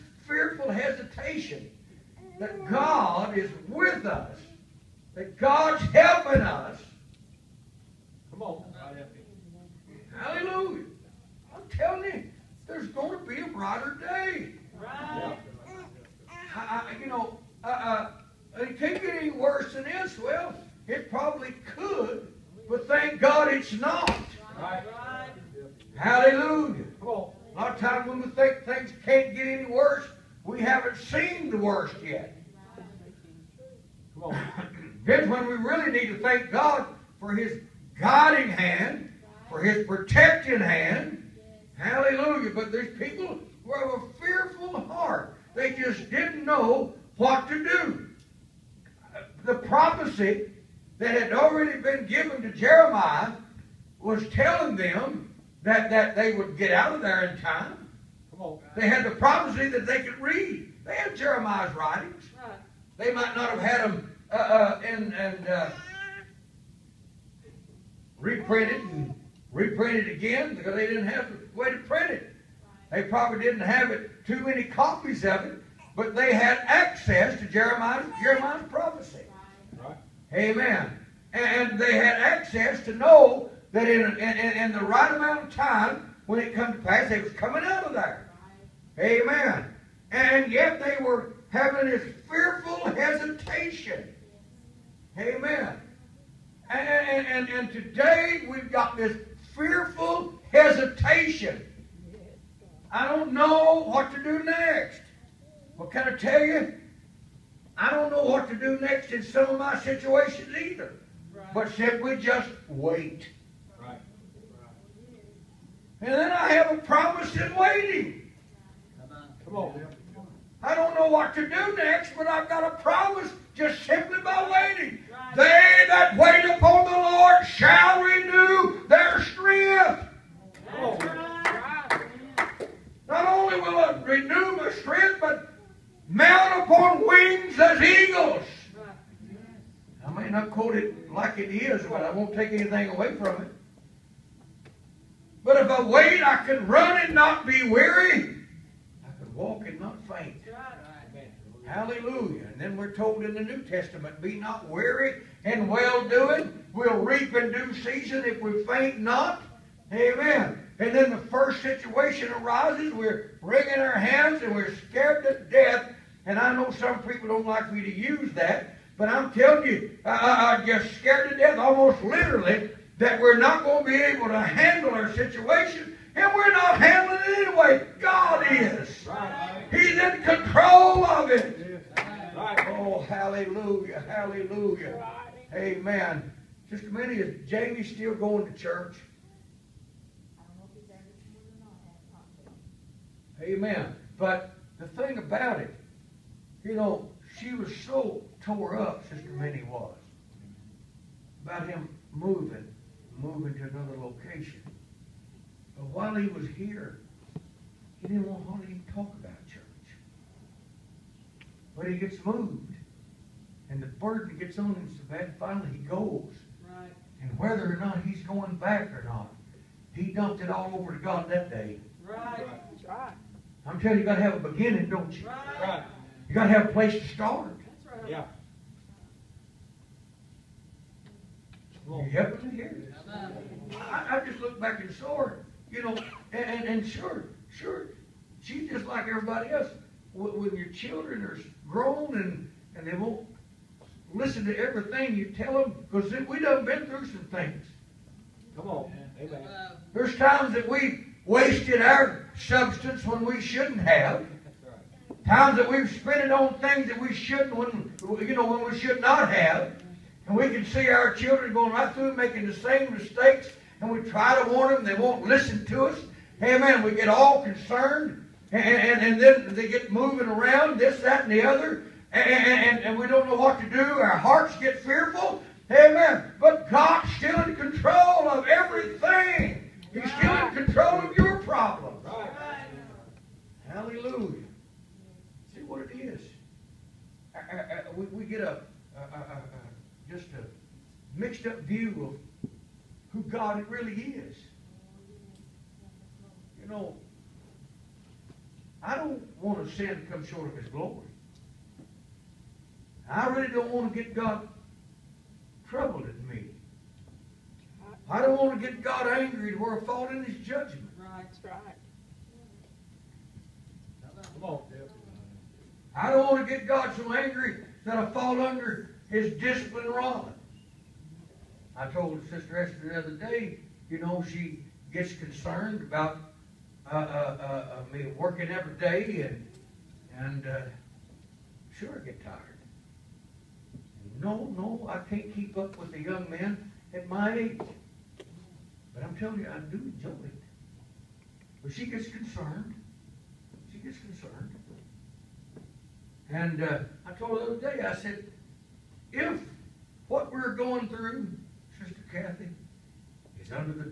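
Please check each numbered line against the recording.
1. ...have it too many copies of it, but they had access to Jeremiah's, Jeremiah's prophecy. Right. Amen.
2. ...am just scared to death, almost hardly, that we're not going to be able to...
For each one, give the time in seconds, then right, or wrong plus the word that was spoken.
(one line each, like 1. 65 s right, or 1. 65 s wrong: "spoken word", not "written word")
1. 73 s right
2. 170 s wrong: "literally", not "hardly".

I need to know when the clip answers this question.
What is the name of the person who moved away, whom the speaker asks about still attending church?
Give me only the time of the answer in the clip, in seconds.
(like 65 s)
187 s.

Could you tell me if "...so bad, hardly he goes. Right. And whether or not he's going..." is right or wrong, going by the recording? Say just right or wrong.
wrong.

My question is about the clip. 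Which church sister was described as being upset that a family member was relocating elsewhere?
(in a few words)
Sister Minnie.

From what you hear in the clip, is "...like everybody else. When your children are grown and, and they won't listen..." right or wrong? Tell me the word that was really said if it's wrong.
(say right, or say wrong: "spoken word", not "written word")
right.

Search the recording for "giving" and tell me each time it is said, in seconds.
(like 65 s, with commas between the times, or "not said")
not said.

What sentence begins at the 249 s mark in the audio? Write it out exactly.
There's times that we wasted our substance when we shouldn't have.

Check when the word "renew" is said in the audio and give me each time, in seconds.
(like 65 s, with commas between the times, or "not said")
128 s, 134 s.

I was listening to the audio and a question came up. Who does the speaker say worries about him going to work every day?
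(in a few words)
Sister Esther.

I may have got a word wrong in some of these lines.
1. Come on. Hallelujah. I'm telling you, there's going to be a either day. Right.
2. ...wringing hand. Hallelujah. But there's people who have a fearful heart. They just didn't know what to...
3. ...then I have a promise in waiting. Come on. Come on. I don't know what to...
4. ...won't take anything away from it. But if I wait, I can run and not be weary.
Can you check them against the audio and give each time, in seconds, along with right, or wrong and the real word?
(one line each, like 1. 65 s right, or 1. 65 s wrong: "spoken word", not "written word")
1. 8 s wrong: "brighter", not "either"
2. 39 s wrong: "protecting", not "wringing"
3. 116 s right
4. 142 s right.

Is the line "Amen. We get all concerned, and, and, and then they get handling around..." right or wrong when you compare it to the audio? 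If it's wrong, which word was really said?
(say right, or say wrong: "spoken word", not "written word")
wrong: "moving", not "handling".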